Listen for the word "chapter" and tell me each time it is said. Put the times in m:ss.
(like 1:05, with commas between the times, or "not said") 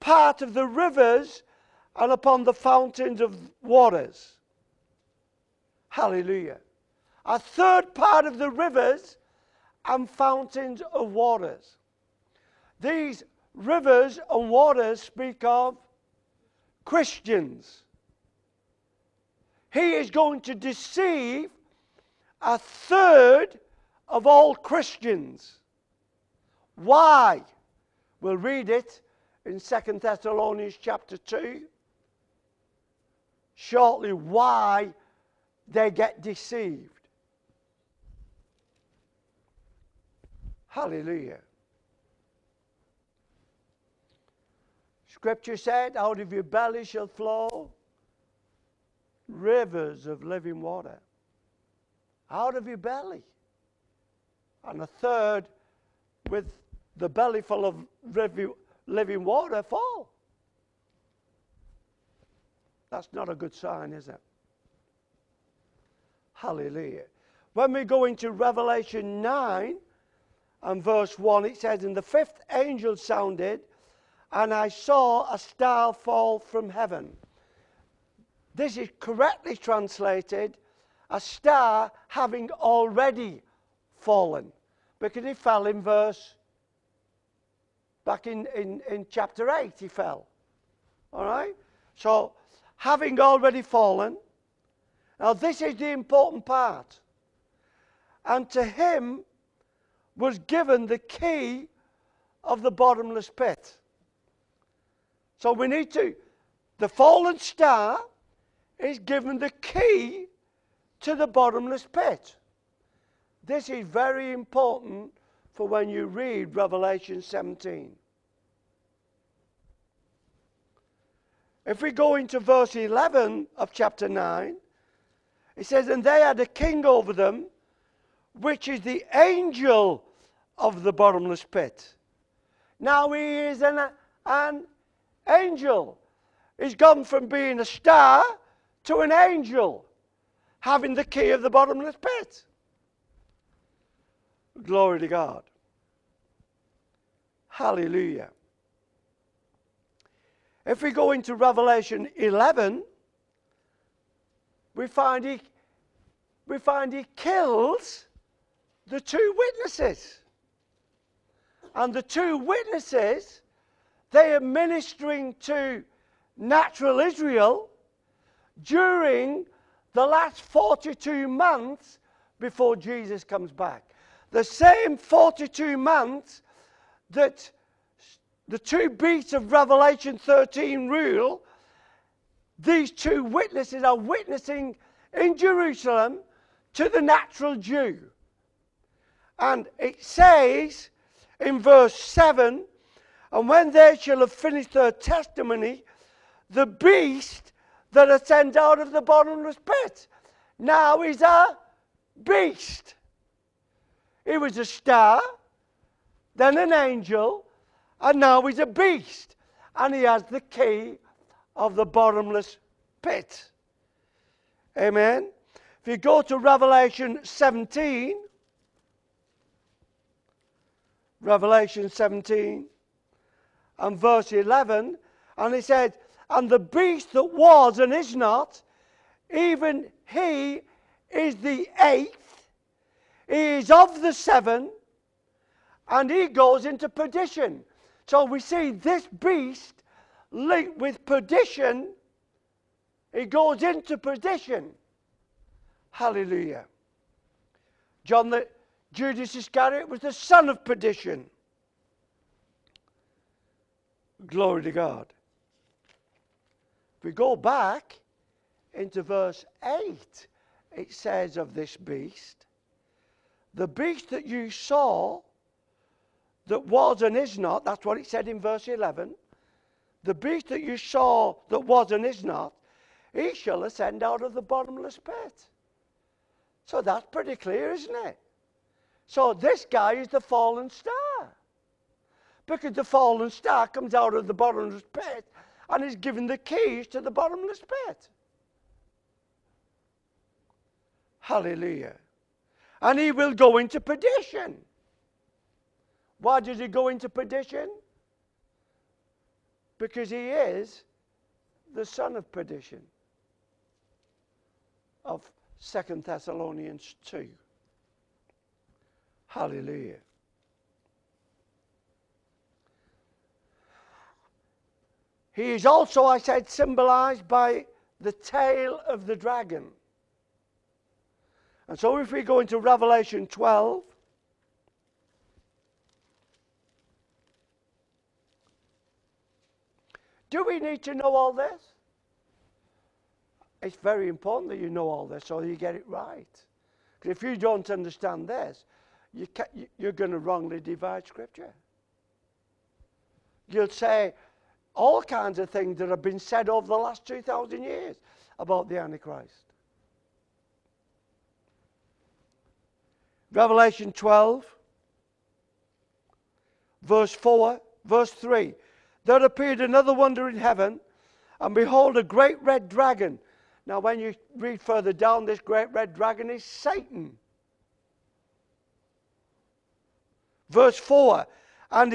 0:30, 1:29, 2:03.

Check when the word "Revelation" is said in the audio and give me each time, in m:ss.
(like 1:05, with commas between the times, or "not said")
1:08, 1:56, 2:31, 2:59, 3:36, 3:41, 5:22, 5:53.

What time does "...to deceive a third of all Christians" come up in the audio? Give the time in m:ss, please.
0:20.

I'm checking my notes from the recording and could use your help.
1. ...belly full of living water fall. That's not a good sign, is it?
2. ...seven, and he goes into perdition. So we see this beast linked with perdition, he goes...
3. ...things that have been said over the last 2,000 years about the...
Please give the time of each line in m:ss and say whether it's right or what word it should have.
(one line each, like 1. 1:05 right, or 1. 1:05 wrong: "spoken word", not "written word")
1. 0:57 right
2. 3:54 right
3. 5:45 right.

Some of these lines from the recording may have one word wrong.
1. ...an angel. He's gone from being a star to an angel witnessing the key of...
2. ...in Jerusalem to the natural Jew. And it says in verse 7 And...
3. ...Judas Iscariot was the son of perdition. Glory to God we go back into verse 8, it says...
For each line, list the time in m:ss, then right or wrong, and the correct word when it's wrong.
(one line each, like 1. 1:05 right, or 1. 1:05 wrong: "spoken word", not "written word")
1. 2:14 wrong: "having", not "witnessing"
2. 3:05 right
3. 4:08 right.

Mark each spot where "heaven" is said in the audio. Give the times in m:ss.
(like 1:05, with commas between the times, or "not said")
1:16, 6:00.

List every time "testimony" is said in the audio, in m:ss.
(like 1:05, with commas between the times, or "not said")
3:14.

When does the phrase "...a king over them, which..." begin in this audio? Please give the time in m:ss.
2:06.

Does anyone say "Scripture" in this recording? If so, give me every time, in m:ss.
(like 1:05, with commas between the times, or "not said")
0:45, 5:41.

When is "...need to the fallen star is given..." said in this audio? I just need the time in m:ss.
1:45.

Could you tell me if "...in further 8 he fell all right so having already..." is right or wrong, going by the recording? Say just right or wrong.
wrong.